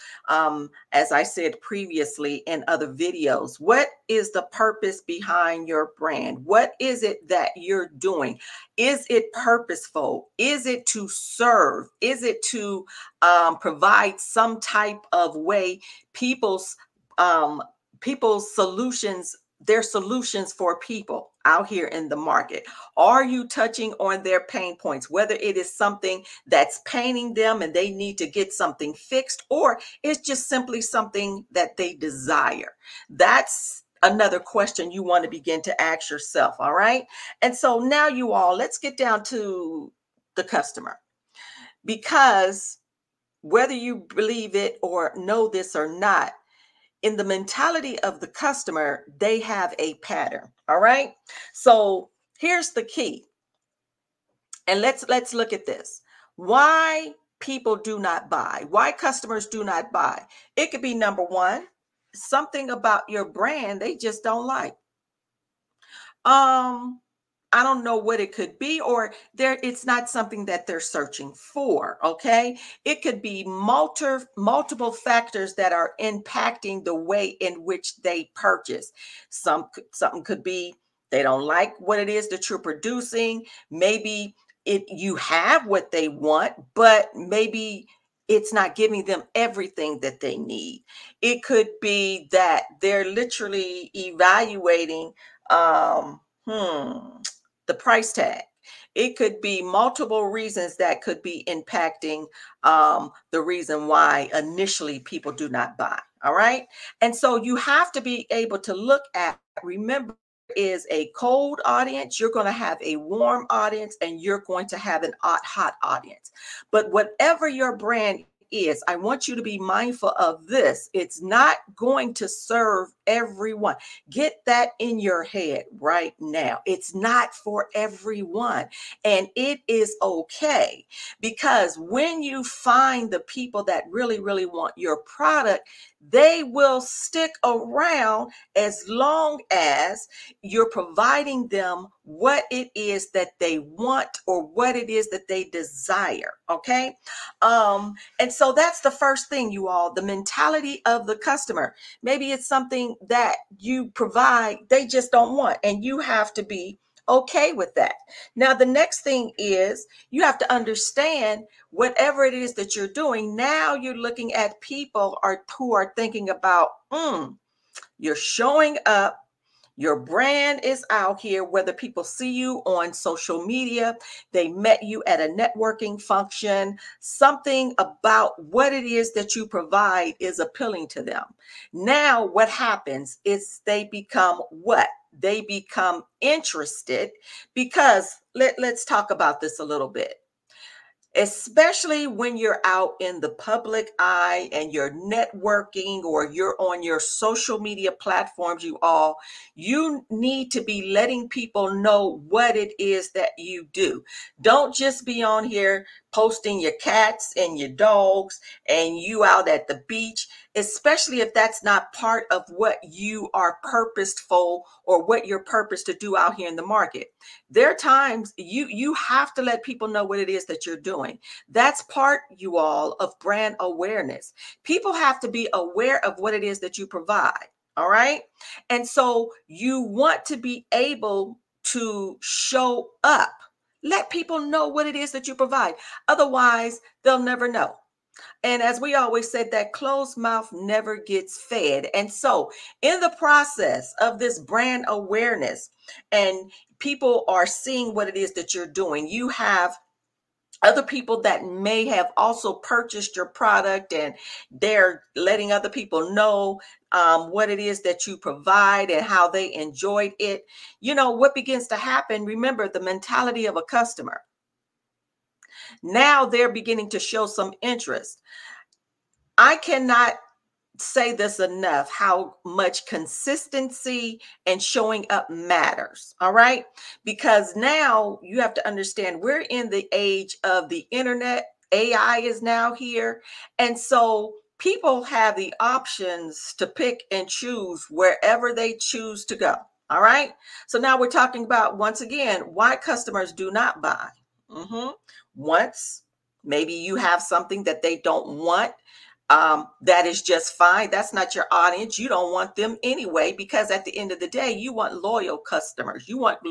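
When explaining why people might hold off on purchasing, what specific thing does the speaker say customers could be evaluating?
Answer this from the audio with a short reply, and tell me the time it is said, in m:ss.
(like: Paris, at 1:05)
The price tag, at 1:37.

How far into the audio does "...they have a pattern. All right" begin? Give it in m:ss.
0:49.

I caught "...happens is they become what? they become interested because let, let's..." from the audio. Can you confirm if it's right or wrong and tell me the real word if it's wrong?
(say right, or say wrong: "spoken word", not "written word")
right.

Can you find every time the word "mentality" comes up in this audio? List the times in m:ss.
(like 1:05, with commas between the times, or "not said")
0:47, 2:30, 4:22.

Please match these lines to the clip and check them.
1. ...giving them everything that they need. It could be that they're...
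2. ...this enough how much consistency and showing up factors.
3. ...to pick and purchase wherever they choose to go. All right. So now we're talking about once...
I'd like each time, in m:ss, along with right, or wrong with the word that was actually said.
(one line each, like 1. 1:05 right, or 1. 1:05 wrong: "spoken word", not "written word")
1. 1:28 right
2. 4:31 wrong: "matters", not "factors"
3. 4:46 wrong: "choose", not "purchase".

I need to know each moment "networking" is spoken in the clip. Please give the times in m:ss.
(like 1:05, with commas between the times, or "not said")
2:55, 3:14.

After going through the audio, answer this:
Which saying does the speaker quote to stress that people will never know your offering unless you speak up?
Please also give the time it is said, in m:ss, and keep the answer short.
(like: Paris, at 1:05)
Closed mouth never gets fed, at 3:59.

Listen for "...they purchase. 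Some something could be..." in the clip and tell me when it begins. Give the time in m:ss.
1:17.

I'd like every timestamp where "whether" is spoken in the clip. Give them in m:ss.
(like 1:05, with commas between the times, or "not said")
0:25, 0:43, 2:51.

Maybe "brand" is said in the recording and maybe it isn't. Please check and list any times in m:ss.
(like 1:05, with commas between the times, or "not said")
0:05, 1:03, 1:57, 2:49, 3:43, 4:04.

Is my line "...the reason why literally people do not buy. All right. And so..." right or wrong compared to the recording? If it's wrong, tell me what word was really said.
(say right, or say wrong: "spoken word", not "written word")
wrong: "initially", not "literally".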